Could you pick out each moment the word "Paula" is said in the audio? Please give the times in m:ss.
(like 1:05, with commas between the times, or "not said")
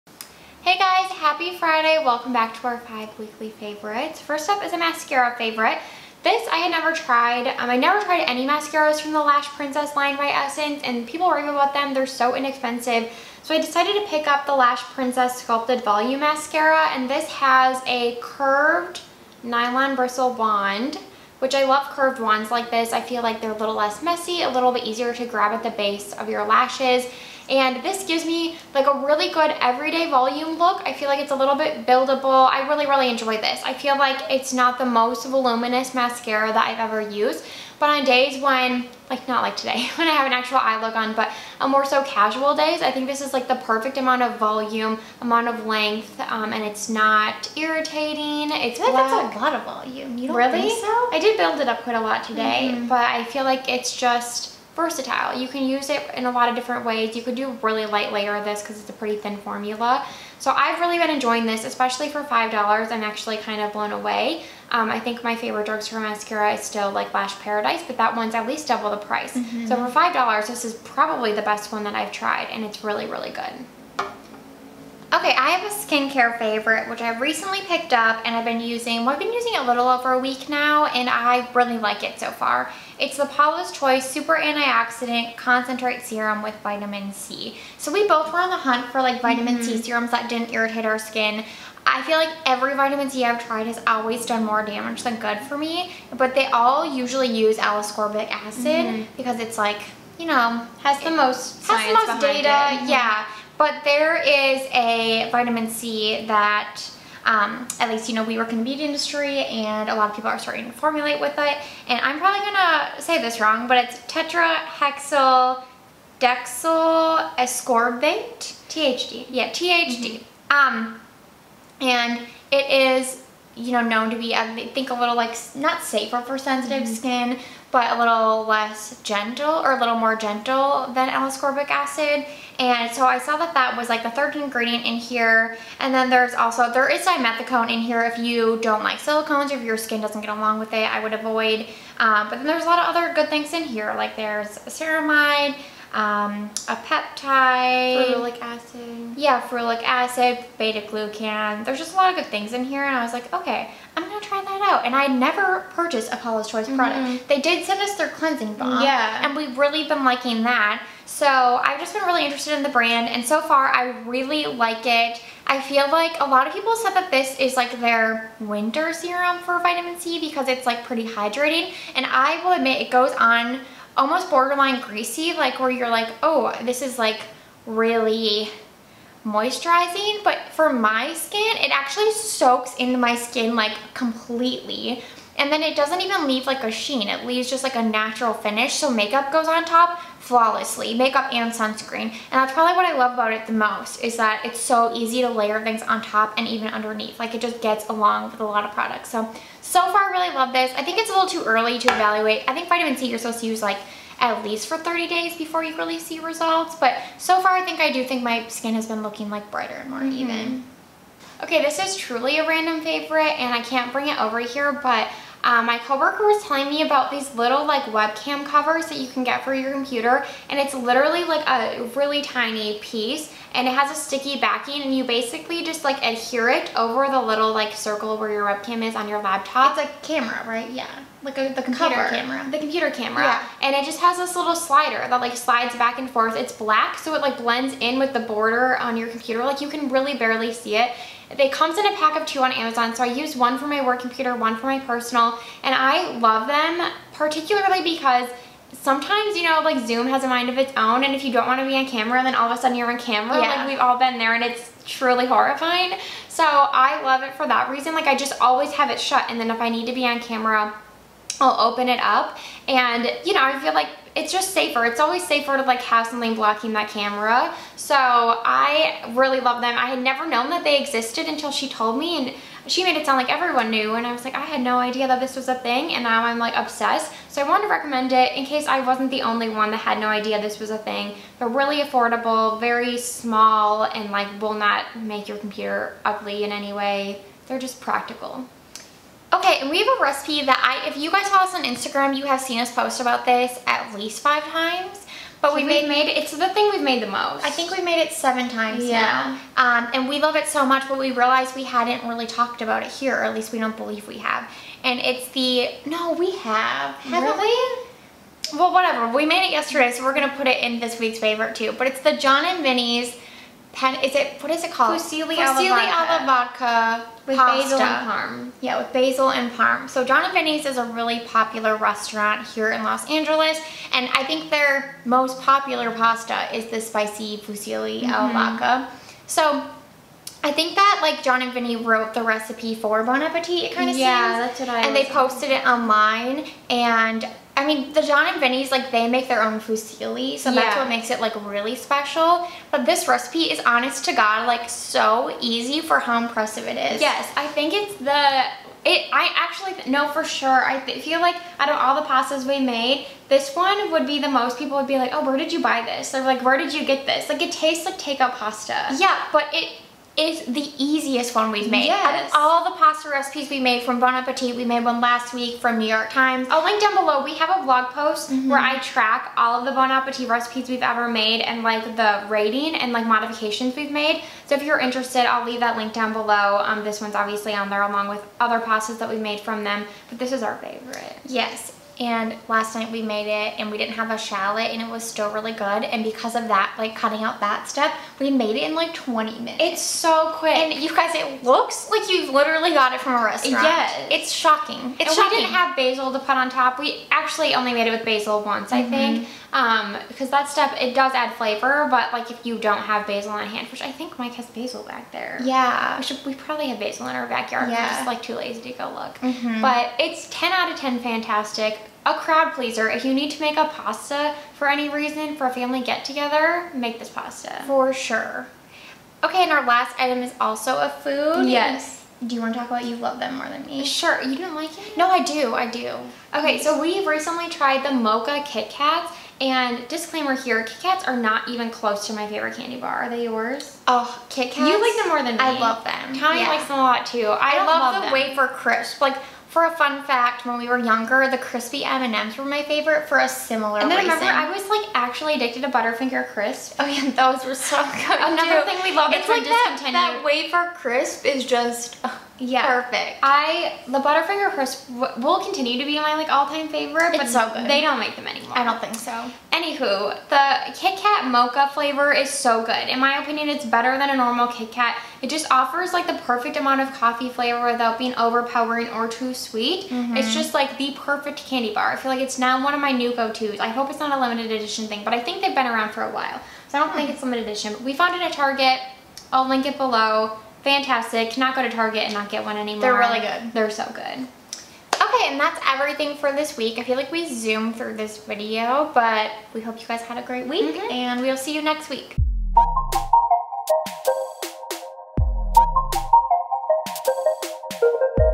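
1:23, 2:36.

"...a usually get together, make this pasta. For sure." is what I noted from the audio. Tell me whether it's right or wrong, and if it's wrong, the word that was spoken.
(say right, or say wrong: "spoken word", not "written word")
wrong: "family", not "usually".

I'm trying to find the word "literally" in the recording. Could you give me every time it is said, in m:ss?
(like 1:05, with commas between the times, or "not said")
3:40, 6:32.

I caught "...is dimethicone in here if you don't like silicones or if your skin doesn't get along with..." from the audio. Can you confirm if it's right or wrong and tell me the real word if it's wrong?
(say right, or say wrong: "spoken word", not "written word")
right.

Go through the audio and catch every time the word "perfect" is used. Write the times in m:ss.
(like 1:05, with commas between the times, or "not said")
0:43, 7:32, 7:46, 7:51.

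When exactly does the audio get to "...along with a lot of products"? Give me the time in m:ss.
3:17.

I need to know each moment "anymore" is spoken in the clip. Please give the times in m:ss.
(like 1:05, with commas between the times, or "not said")
7:38, 8:02.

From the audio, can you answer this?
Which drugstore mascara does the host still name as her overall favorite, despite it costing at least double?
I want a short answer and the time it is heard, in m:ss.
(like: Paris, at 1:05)
Lash Paradise, at 1:07.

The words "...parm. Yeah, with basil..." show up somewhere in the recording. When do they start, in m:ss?
5:18.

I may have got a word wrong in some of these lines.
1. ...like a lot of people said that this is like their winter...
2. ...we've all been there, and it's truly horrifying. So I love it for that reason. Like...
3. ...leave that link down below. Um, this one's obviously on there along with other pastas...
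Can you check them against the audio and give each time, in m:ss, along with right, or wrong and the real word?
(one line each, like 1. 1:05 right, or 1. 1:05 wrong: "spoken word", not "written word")
1. 2:46 right
2. 4:13 right
3. 6:15 right.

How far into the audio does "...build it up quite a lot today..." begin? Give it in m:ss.
0:51.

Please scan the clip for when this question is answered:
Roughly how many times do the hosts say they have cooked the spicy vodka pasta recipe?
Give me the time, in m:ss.
4:58.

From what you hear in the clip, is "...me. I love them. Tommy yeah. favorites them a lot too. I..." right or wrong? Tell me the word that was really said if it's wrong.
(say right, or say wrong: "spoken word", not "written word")
wrong: "likes", not "favorites".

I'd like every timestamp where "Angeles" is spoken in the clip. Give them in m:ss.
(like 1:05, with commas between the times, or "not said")
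5:23.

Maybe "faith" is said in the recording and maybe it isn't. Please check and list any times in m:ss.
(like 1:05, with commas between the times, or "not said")
not said.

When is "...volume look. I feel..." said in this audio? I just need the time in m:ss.
0:30.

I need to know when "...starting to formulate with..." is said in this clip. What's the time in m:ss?
1:50.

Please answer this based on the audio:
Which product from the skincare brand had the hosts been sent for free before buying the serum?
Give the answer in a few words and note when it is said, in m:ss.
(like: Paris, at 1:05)
cleansing balm, at 2:38.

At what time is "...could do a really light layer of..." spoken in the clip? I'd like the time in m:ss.
0:57.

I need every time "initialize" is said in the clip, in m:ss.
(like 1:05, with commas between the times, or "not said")
not said.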